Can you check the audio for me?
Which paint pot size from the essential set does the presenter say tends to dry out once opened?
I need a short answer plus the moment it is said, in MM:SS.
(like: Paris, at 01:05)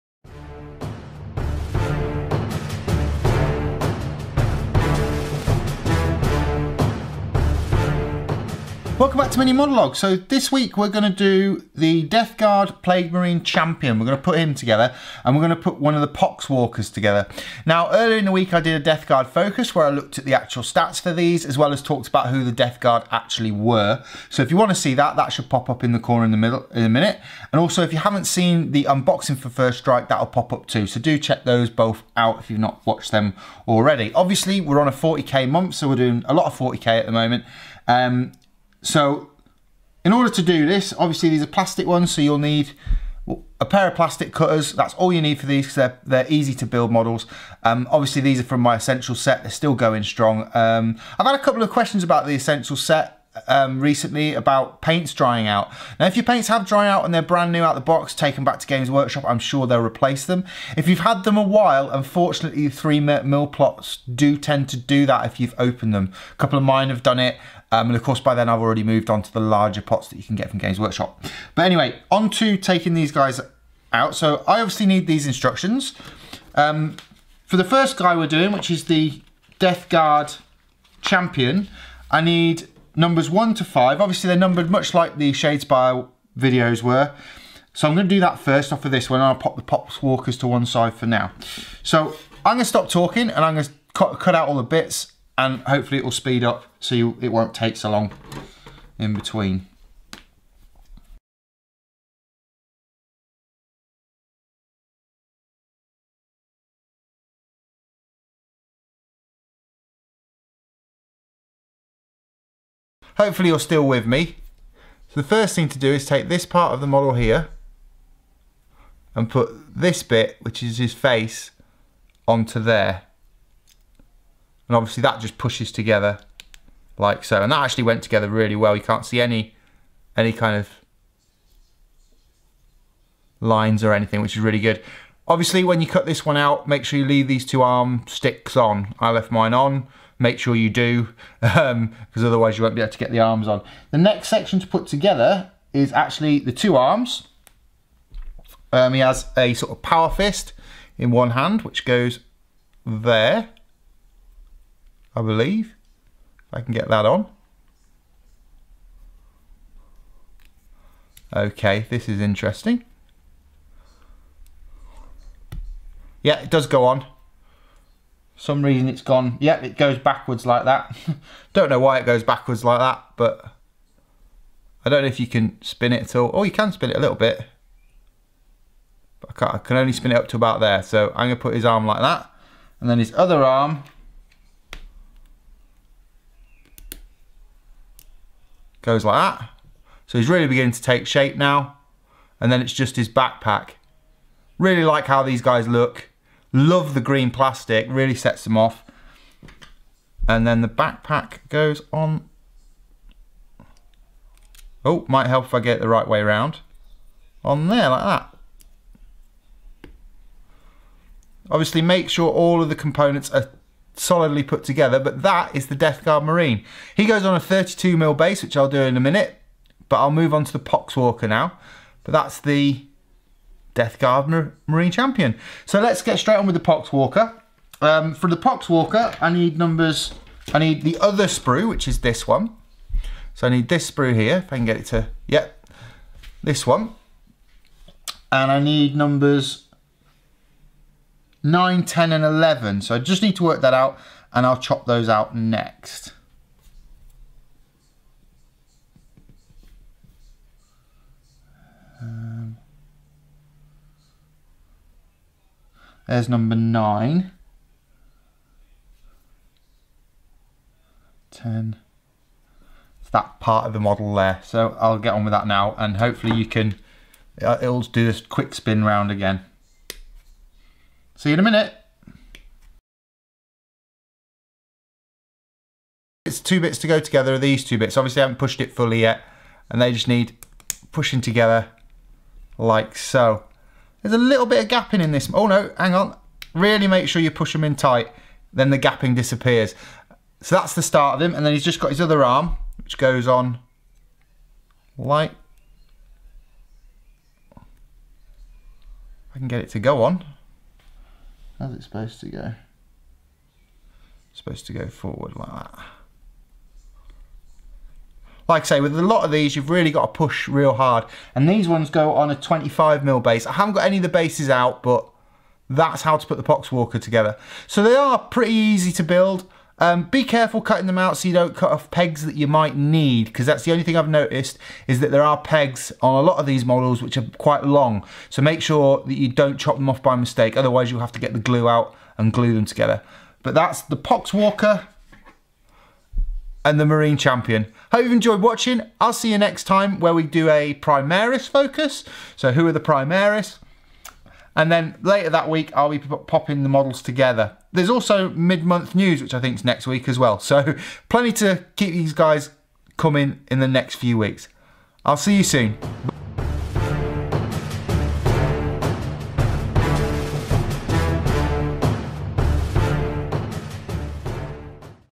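3 mil, at 01:02.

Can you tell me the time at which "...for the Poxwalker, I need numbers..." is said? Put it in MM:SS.
03:48.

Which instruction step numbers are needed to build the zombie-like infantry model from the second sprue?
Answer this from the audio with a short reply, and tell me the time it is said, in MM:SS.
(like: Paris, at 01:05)
9, 10, and 11, at 04:01.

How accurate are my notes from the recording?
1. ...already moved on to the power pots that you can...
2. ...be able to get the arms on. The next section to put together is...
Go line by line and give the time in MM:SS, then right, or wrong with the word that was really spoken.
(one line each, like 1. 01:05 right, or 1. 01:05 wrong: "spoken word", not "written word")
1. 01:08 wrong: "larger", not "power"
2. 02:22 right.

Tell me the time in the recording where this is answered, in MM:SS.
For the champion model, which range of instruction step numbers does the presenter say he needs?
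01:23.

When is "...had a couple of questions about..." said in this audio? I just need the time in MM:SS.
00:51.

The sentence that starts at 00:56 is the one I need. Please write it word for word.
Now, if your paints have dried out and they're brand new out the box, take them back to Games Workshop.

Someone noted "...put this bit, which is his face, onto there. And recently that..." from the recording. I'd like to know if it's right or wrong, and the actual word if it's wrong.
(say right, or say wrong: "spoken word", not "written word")
wrong: "obviously", not "recently".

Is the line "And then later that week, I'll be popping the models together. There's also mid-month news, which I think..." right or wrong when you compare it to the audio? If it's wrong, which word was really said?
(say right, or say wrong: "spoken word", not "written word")
right.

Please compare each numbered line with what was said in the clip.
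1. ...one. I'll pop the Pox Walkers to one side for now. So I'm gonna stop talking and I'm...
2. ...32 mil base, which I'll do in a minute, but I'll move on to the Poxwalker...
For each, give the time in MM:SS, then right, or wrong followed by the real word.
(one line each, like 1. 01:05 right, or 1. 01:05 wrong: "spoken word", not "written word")
1. 01:29 right
2. 03:37 right.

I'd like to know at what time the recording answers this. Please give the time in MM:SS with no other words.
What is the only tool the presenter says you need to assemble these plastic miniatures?
00:43.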